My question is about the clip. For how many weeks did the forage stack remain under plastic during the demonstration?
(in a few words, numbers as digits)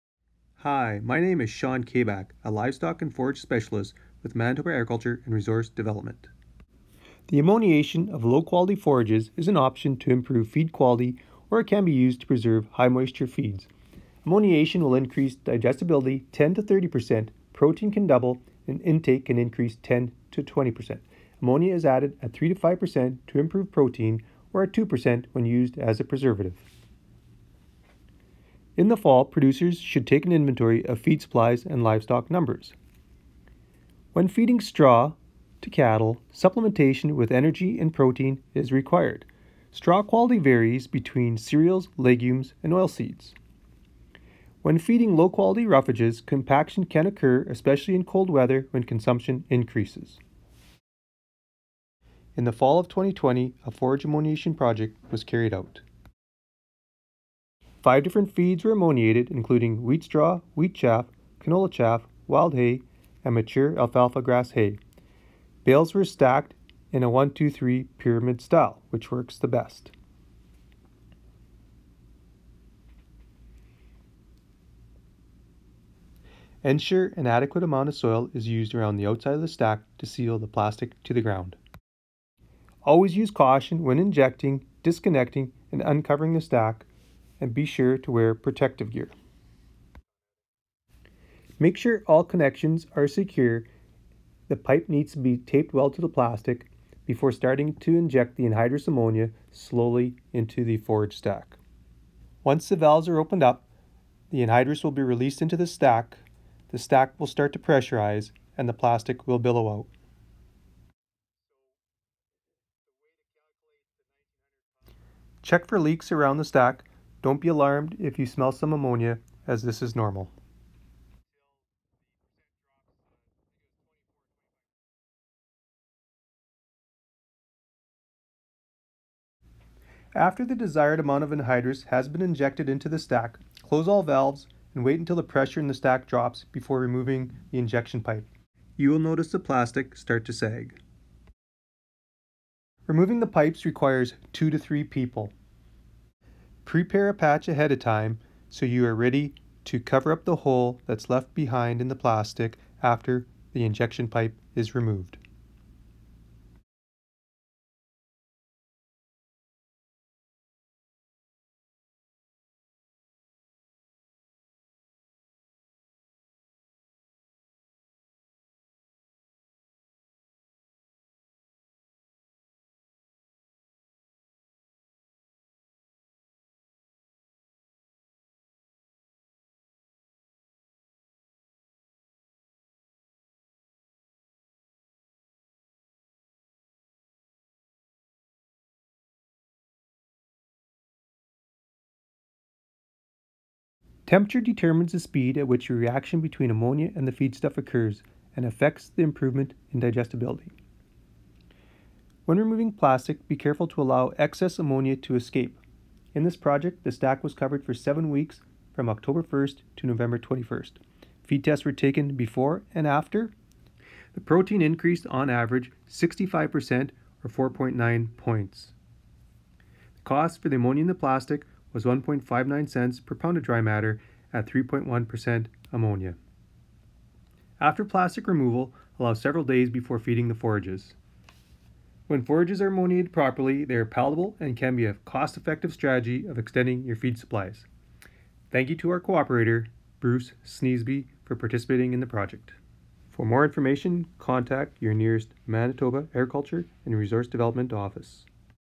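7.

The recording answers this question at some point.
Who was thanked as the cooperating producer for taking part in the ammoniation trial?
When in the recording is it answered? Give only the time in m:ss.
4:00.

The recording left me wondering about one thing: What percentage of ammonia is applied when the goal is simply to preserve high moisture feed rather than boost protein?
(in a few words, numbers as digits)
2%.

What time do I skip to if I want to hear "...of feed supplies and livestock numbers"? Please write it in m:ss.
0:30.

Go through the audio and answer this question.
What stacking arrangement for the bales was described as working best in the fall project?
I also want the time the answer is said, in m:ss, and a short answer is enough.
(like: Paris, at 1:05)
1-2-3 pyramid, at 1:07.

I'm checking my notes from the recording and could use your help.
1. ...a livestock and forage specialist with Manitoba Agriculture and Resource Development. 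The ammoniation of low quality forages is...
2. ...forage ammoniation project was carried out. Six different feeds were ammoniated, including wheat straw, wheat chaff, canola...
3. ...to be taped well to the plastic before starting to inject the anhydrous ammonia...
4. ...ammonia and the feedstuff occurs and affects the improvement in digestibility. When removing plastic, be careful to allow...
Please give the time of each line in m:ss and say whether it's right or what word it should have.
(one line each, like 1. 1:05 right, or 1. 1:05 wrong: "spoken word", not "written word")
1. 0:02 right
2. 0:53 wrong: "Five", not "Six"
3. 1:35 right
4. 3:16 right.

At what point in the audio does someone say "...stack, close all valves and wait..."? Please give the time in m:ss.
2:12.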